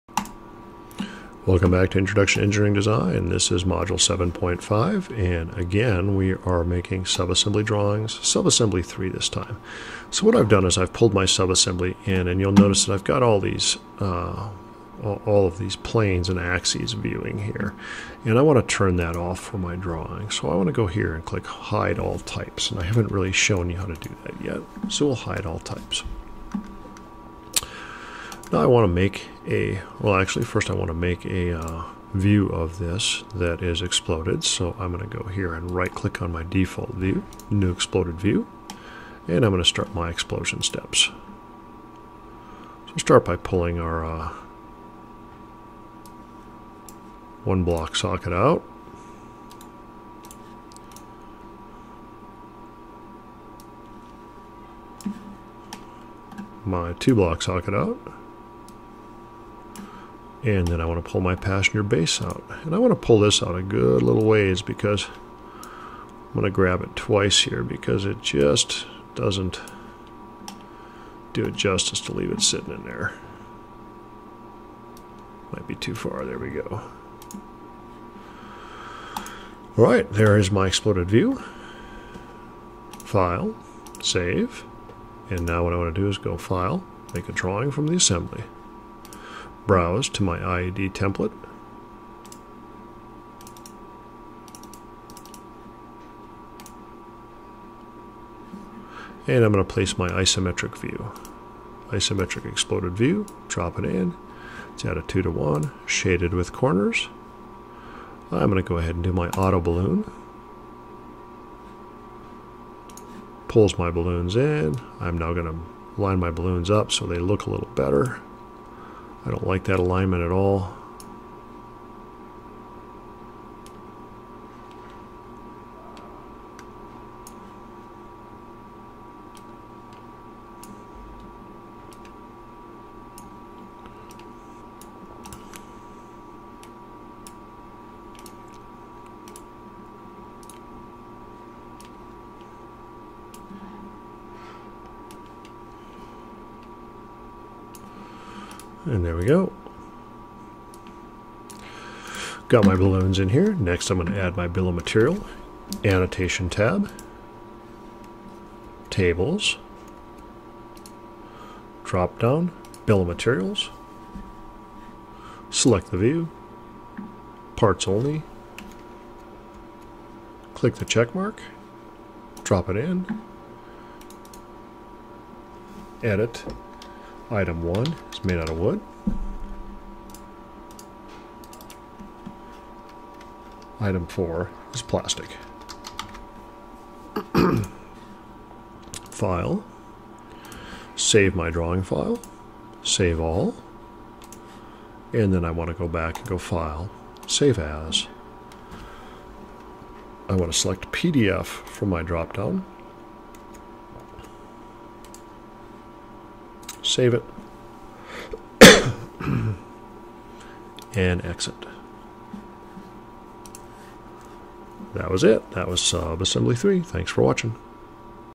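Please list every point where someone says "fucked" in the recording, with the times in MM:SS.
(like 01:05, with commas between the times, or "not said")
not said.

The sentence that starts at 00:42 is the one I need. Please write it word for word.
So start by pulling our uh, one block socket out.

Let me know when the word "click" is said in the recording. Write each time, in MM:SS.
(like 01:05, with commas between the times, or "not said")
00:21, 00:35, 02:50.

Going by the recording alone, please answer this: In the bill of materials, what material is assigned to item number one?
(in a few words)
Wood.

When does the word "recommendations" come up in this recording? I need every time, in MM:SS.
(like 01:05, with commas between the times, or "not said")
not said.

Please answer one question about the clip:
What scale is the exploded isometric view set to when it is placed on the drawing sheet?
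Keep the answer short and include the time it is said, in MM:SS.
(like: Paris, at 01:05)
2 to 1, at 01:45.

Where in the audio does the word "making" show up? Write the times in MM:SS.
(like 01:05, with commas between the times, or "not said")
00:06.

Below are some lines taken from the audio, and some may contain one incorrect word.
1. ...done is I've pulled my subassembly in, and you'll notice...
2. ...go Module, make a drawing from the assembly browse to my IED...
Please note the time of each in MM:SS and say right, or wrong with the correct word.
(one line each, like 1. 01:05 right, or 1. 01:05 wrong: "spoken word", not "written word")
1. 00:10 right
2. 01:26 wrong: "File", not "Module".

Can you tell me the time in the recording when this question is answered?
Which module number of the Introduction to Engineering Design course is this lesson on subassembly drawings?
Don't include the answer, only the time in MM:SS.
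00:03.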